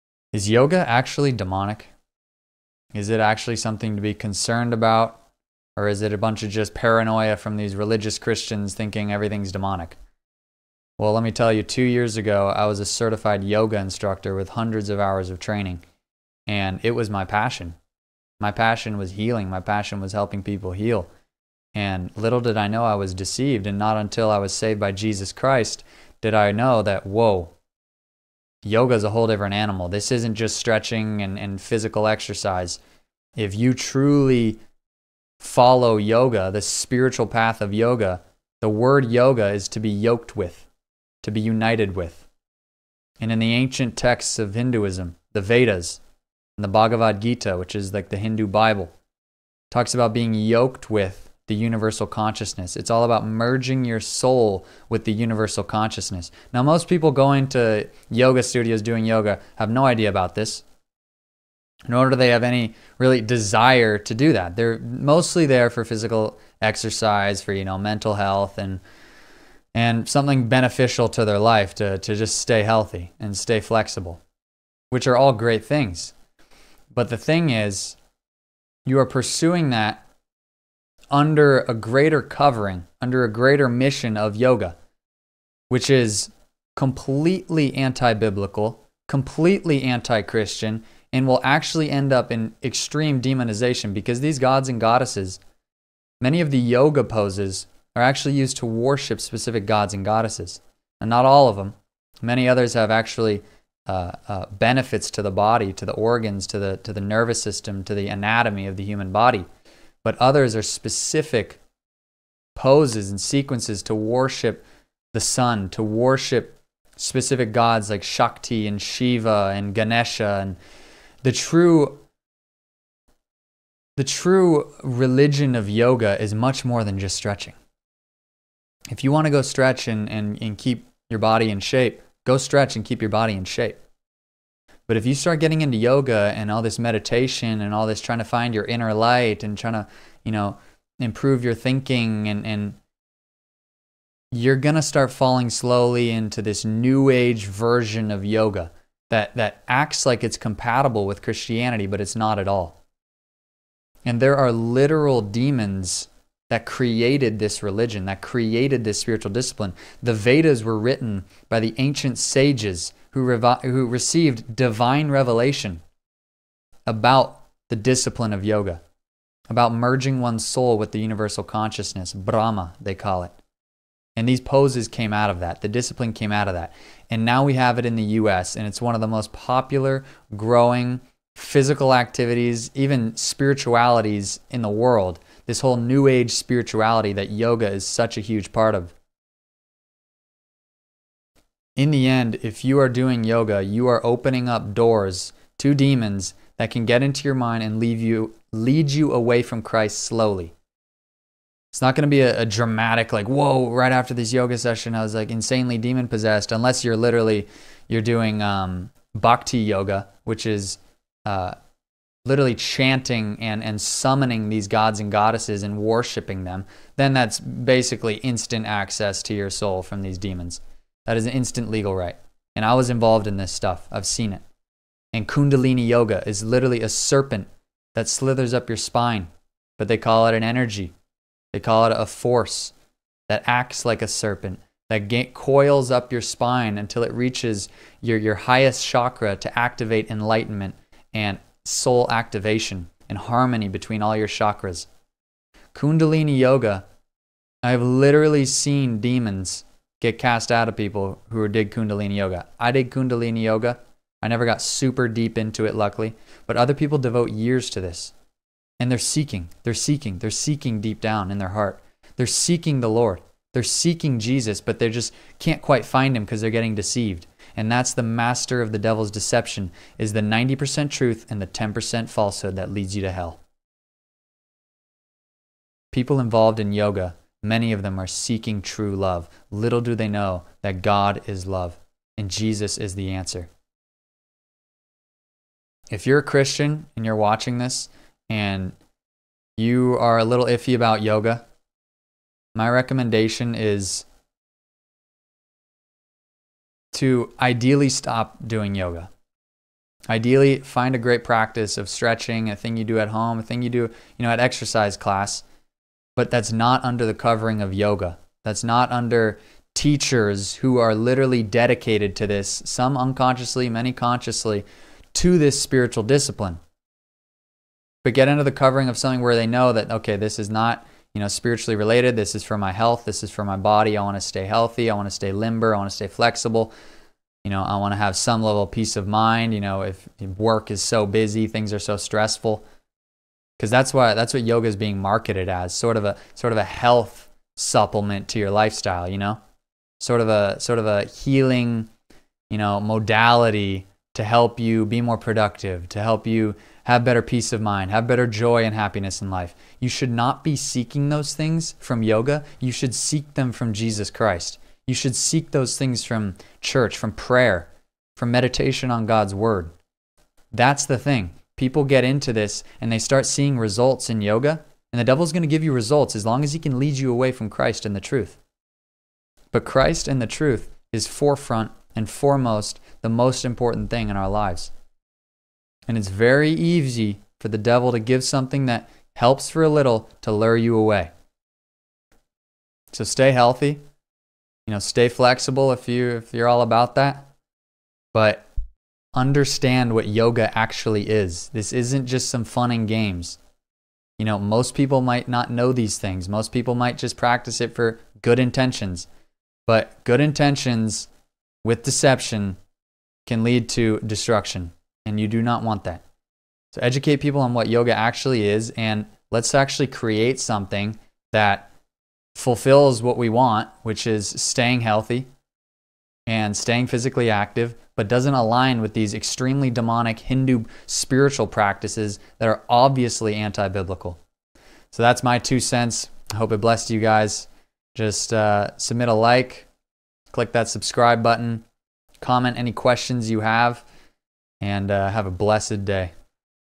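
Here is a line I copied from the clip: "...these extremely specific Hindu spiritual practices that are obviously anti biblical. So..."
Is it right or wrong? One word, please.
wrong.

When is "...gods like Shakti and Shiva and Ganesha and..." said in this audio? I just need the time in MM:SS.
01:57.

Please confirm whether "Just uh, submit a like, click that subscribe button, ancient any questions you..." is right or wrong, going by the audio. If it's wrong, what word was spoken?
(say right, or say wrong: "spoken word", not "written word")
wrong: "comment", not "ancient".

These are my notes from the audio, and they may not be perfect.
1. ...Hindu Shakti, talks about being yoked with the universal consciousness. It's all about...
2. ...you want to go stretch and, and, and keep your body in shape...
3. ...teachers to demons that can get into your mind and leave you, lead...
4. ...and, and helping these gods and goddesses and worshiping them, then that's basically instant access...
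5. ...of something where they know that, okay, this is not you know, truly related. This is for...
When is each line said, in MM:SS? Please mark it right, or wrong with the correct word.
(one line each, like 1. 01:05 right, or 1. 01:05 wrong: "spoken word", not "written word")
1. 00:48 wrong: "Bible", not "Shakti"
2. 02:09 right
3. 03:14 wrong: "doors", not "teachers"
4. 03:33 wrong: "summoning", not "helping"
5. 05:18 wrong: "spiritually", not "truly".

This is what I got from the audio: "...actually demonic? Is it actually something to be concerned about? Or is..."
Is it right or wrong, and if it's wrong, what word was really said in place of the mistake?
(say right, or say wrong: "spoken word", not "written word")
right.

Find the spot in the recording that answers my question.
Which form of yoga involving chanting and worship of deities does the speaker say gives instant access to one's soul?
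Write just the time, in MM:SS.
03:29.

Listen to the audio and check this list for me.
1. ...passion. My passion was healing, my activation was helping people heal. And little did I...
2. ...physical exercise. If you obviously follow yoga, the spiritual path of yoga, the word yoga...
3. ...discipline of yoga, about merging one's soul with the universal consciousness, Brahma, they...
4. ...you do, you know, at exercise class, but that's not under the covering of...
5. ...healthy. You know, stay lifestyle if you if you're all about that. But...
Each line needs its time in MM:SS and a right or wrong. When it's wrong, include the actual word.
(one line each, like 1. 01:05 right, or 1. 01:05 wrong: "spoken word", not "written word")
1. 00:17 wrong: "passion", not "activation"
2. 00:31 wrong: "truly", not "obviously"
3. 02:47 right
4. 05:03 right
5. 06:23 wrong: "flexible", not "lifestyle".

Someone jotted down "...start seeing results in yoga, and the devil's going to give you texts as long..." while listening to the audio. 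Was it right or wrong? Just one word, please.
wrong.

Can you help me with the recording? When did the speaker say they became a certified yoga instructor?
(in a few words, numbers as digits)
2 years ago.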